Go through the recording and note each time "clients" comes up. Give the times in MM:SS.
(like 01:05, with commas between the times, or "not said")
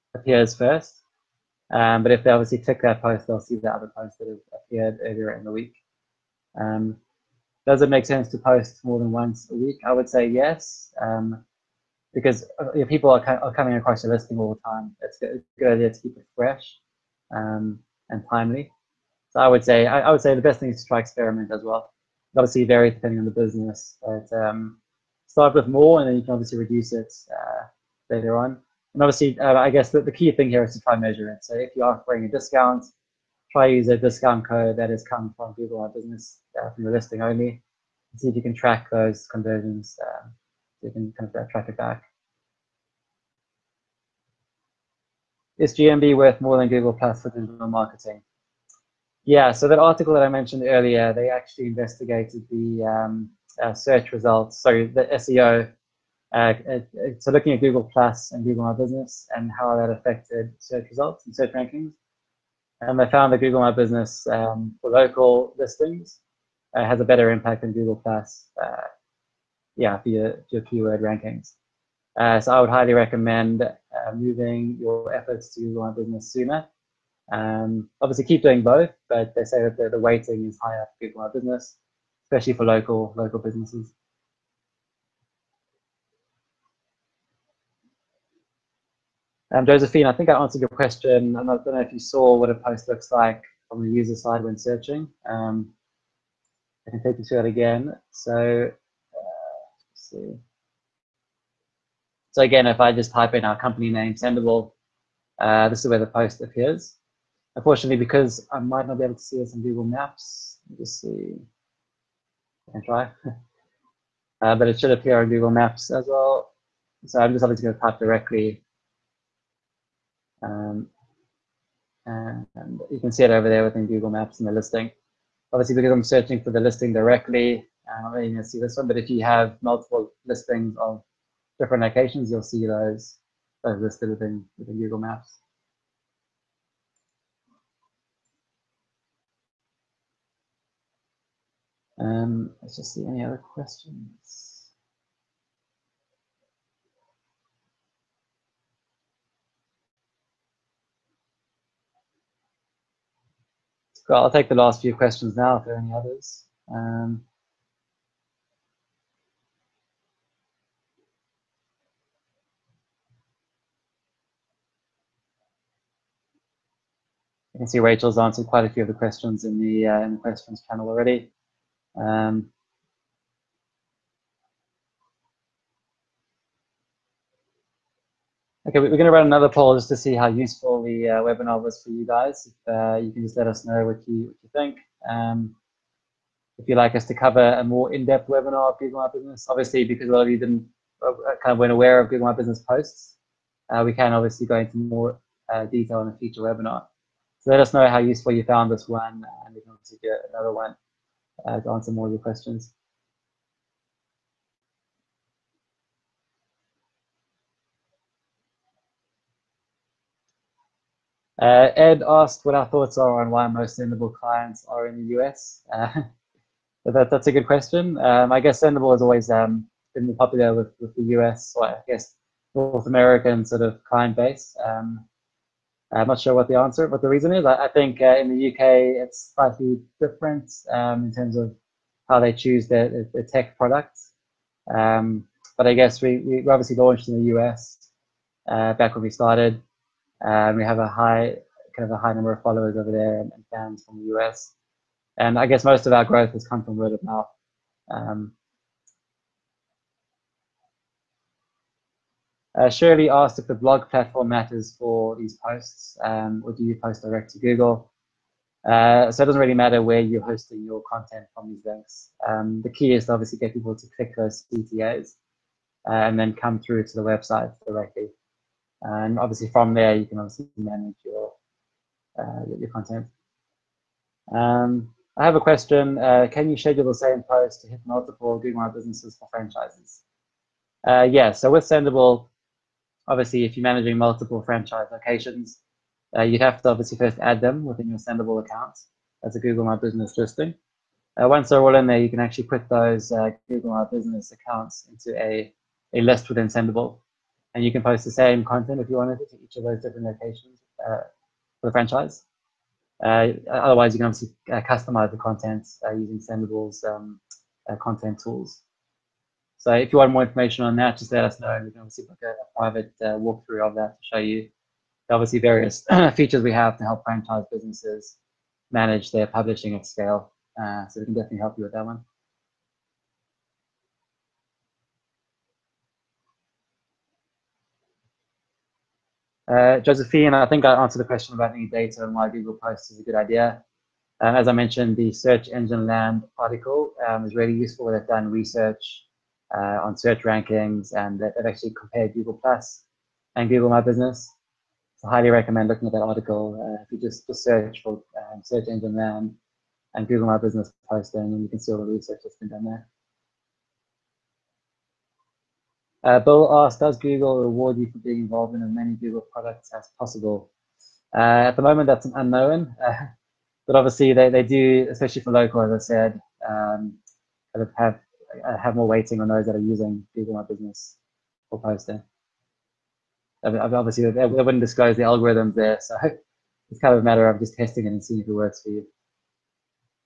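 03:34, 03:43.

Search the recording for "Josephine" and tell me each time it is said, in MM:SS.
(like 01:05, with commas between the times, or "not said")
01:29, 05:29.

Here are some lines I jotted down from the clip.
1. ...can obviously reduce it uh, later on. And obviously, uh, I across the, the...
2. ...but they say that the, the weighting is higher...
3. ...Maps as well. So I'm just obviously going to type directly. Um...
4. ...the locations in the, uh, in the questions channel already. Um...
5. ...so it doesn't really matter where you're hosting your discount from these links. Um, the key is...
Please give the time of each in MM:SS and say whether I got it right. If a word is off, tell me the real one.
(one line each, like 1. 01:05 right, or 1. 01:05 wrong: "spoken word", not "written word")
1. 00:26 wrong: "guess", not "across"
2. 01:19 right
3. 01:55 right
4. 02:48 wrong: "questions", not "locations"
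5. 04:19 wrong: "content", not "discount".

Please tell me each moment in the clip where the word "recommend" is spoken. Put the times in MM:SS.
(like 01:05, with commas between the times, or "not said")
01:12, 05:45.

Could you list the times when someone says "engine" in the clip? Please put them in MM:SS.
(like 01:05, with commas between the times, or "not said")
05:35, 05:48.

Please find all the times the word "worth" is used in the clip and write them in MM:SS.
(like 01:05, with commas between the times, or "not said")
00:46.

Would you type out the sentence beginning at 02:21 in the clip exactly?
Um, let's just see any other questions.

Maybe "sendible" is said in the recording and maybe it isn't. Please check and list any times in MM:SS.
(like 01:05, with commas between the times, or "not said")
01:44, 03:33, 03:38, 04:41, 04:47, 04:56, 05:06.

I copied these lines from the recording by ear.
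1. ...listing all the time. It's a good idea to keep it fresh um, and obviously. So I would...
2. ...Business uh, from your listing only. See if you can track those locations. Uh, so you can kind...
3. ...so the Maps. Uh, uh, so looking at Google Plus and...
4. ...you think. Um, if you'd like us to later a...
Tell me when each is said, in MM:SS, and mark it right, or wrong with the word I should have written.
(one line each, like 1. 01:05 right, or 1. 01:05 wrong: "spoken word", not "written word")
1. 00:14 wrong: "timely", not "obviously"
2. 00:35 wrong: "conversions", not "locations"
3. 00:54 wrong: "SEO", not "Maps"
4. 03:04 wrong: "cover", not "later".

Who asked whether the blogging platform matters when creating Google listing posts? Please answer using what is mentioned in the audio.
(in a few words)
Shirley.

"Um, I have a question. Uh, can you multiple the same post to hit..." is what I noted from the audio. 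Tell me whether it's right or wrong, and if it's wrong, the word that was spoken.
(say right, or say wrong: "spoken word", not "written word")
wrong: "schedule", not "multiple".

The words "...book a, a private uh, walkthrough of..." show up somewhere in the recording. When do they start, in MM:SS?
05:12.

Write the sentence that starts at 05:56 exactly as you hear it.
Uh, Bill asked, does Google reward you for being involved in as many Google products as possible?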